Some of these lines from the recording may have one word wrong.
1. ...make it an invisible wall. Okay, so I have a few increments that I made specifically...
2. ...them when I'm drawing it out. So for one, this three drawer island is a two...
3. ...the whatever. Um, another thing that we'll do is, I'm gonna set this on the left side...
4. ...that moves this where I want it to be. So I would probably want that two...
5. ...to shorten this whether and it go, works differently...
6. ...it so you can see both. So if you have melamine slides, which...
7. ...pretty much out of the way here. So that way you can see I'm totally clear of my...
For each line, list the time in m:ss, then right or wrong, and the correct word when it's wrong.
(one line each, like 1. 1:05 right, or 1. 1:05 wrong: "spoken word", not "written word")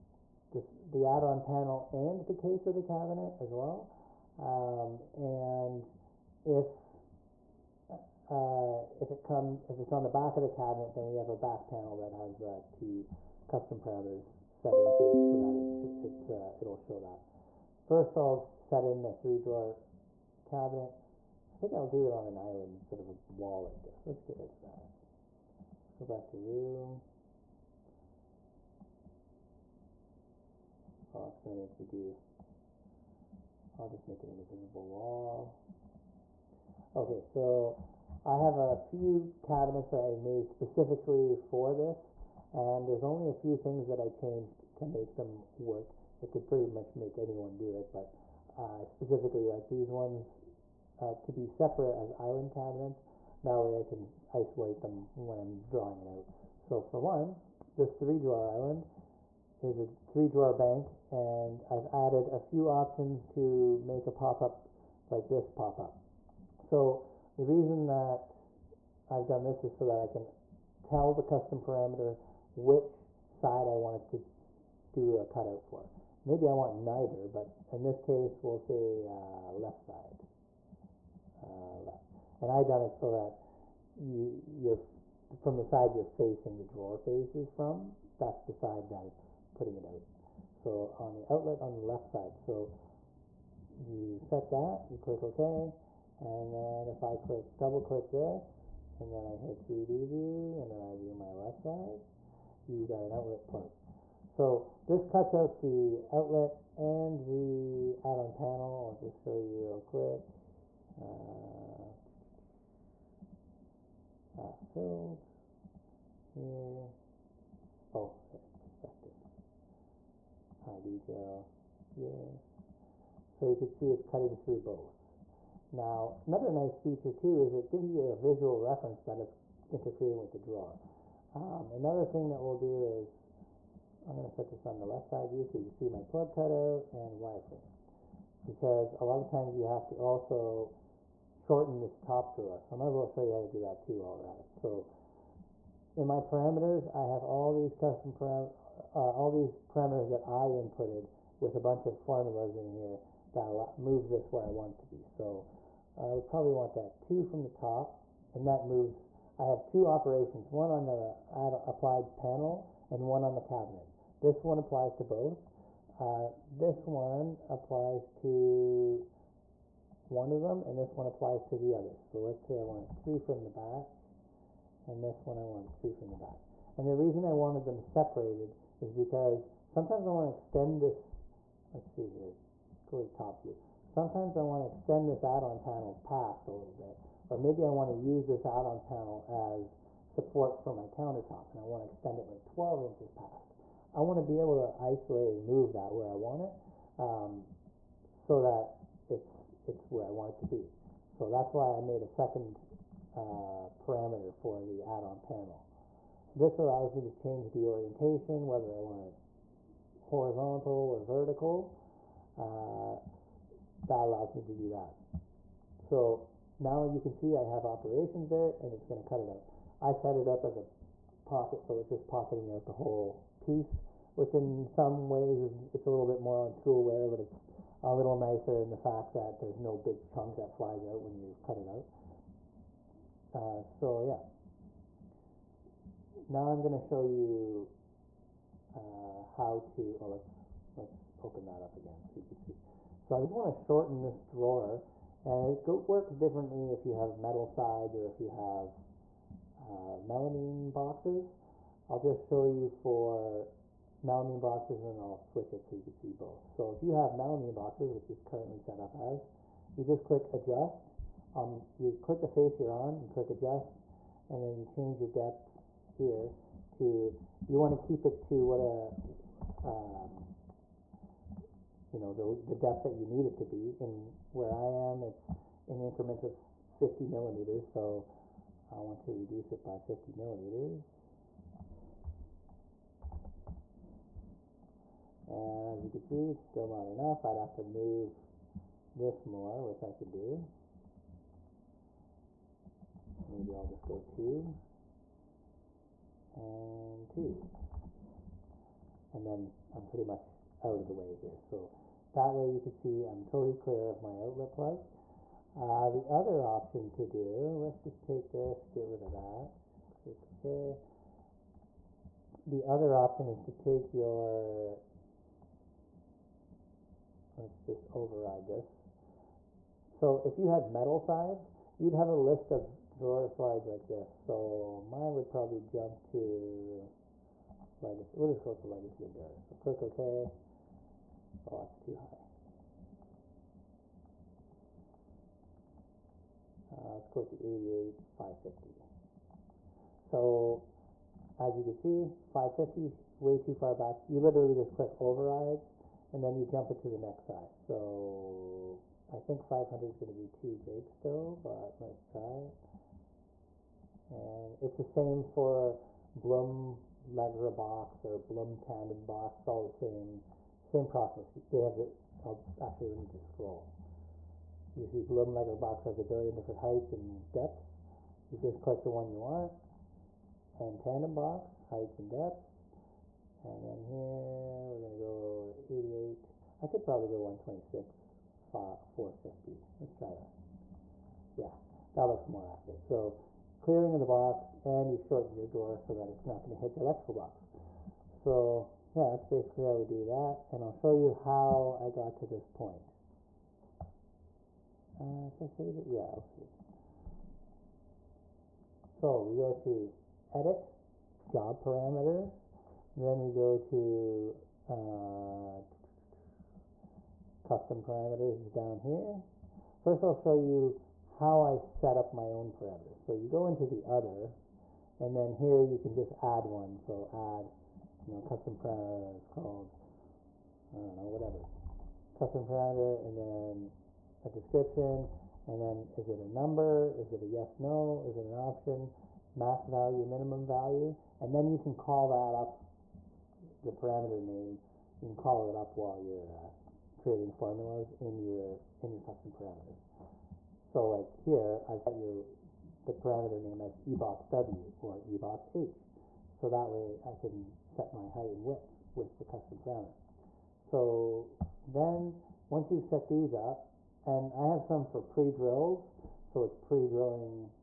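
1. 0:34 wrong: "cabinets", not "increments"
2. 0:54 wrong: "three", not "two"
3. 2:10 wrong: "drawer", not "whatever"
4. 2:33 right
5. 4:03 wrong: "drawer", not "whether"
6. 4:15 wrong: "boxes", not "slides"
7. 4:59 right.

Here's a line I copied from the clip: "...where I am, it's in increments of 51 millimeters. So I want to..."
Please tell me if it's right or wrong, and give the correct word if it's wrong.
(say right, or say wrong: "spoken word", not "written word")
wrong: "50", not "51".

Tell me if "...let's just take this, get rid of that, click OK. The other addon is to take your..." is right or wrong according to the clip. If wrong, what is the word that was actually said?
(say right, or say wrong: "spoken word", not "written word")
wrong: "option", not "addon".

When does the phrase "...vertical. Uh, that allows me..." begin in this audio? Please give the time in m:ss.
3:31.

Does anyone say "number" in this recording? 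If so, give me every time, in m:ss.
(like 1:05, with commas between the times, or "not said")
7:06.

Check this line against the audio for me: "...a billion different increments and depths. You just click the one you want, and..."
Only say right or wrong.
wrong.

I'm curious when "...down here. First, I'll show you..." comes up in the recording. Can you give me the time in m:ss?
6:48.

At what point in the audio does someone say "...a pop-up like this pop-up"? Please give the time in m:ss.
1:04.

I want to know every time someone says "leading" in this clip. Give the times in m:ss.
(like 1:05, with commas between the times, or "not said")
not said.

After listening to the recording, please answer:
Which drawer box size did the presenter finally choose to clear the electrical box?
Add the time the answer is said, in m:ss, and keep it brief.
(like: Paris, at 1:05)
126, 450, at 6:17.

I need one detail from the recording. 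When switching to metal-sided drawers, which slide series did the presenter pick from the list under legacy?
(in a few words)
legacy endurance.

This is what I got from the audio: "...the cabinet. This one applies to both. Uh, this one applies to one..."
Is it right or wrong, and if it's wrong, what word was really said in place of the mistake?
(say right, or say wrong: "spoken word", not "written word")
right.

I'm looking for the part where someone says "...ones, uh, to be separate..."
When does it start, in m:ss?
0:49.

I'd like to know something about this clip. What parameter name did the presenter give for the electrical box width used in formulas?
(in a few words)
eboxw.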